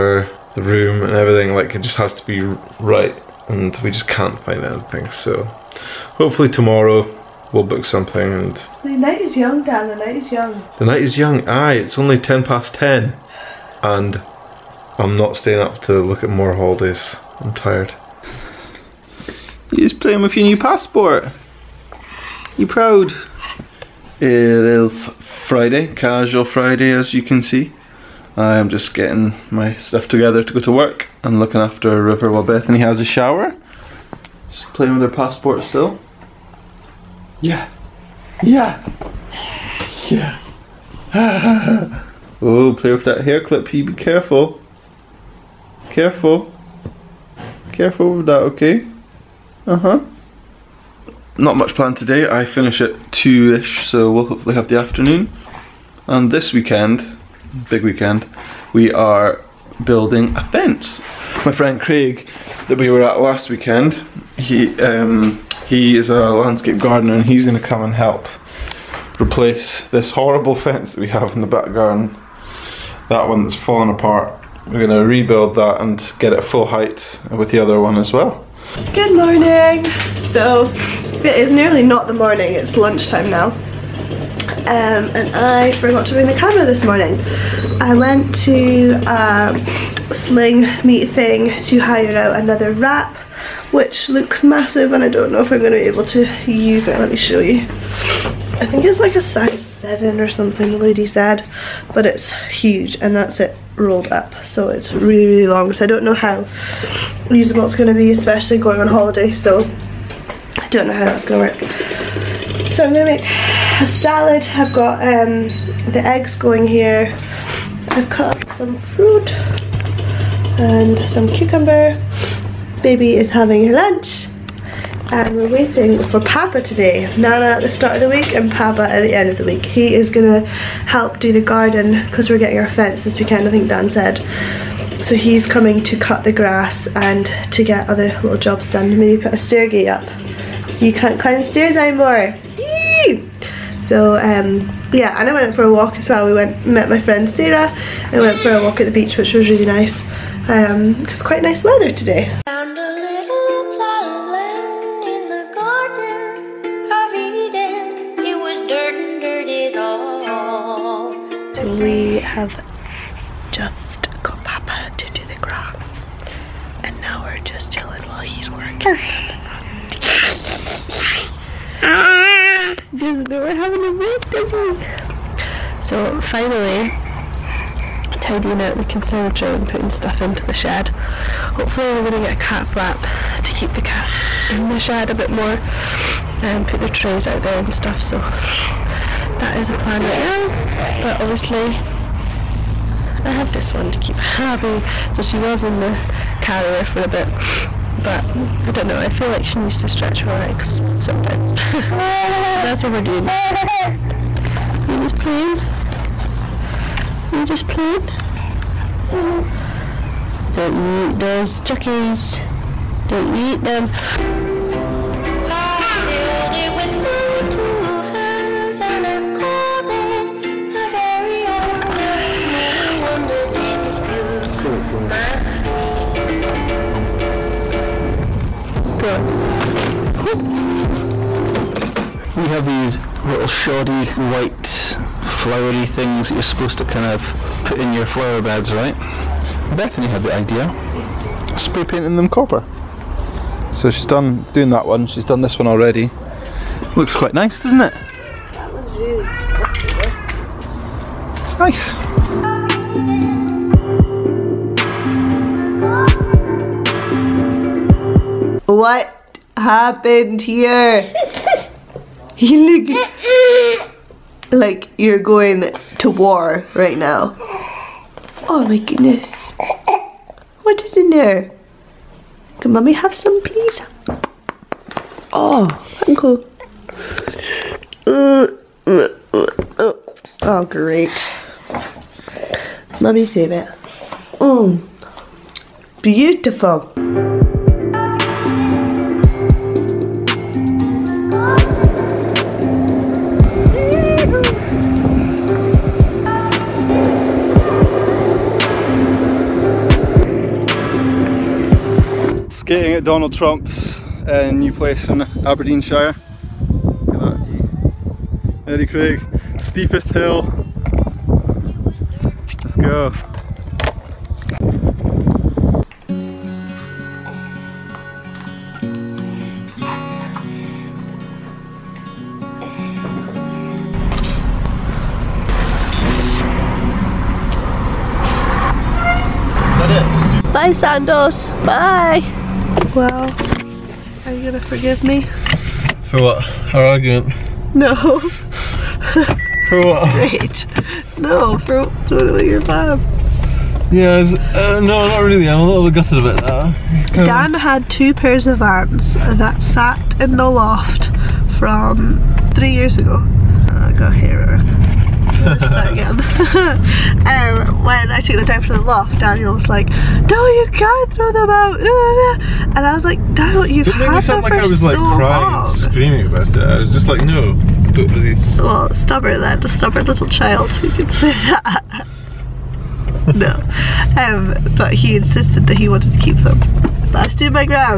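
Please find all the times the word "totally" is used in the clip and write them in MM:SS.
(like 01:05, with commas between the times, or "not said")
05:42.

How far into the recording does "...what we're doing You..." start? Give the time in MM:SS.
03:22.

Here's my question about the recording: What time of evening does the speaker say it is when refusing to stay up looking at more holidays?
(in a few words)
10:10.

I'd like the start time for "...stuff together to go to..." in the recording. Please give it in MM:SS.
00:29.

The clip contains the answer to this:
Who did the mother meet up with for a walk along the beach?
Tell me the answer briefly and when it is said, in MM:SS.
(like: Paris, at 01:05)
Sarah, at 02:27.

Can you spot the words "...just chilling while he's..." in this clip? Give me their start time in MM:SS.
02:47.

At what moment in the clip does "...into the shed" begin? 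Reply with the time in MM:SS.
03:00.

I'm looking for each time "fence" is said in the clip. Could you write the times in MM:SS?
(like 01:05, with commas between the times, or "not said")
01:00, 01:10, 02:12.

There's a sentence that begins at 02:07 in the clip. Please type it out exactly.
Nana at the start of the week and Papa at the end of the week.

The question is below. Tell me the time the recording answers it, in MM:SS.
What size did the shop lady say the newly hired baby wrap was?
01:39.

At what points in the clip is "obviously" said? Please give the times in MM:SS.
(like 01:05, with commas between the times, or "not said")
03:11.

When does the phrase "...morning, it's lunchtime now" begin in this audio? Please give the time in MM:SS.
01:22.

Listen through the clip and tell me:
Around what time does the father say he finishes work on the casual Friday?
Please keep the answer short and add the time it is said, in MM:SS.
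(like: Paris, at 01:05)
2-ish, at 00:53.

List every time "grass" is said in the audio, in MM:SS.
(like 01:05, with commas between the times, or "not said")
02:16, 02:45.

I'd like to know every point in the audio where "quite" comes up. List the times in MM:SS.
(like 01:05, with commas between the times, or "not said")
02:31, 04:07.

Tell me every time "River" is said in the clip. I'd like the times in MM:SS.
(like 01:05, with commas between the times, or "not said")
00:32.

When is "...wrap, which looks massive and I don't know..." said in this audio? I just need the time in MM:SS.
01:32.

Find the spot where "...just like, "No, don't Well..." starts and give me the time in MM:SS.
06:06.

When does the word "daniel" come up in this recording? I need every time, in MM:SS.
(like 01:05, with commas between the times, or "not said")
05:59, 06:03.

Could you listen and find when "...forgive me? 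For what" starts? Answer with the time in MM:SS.
05:34.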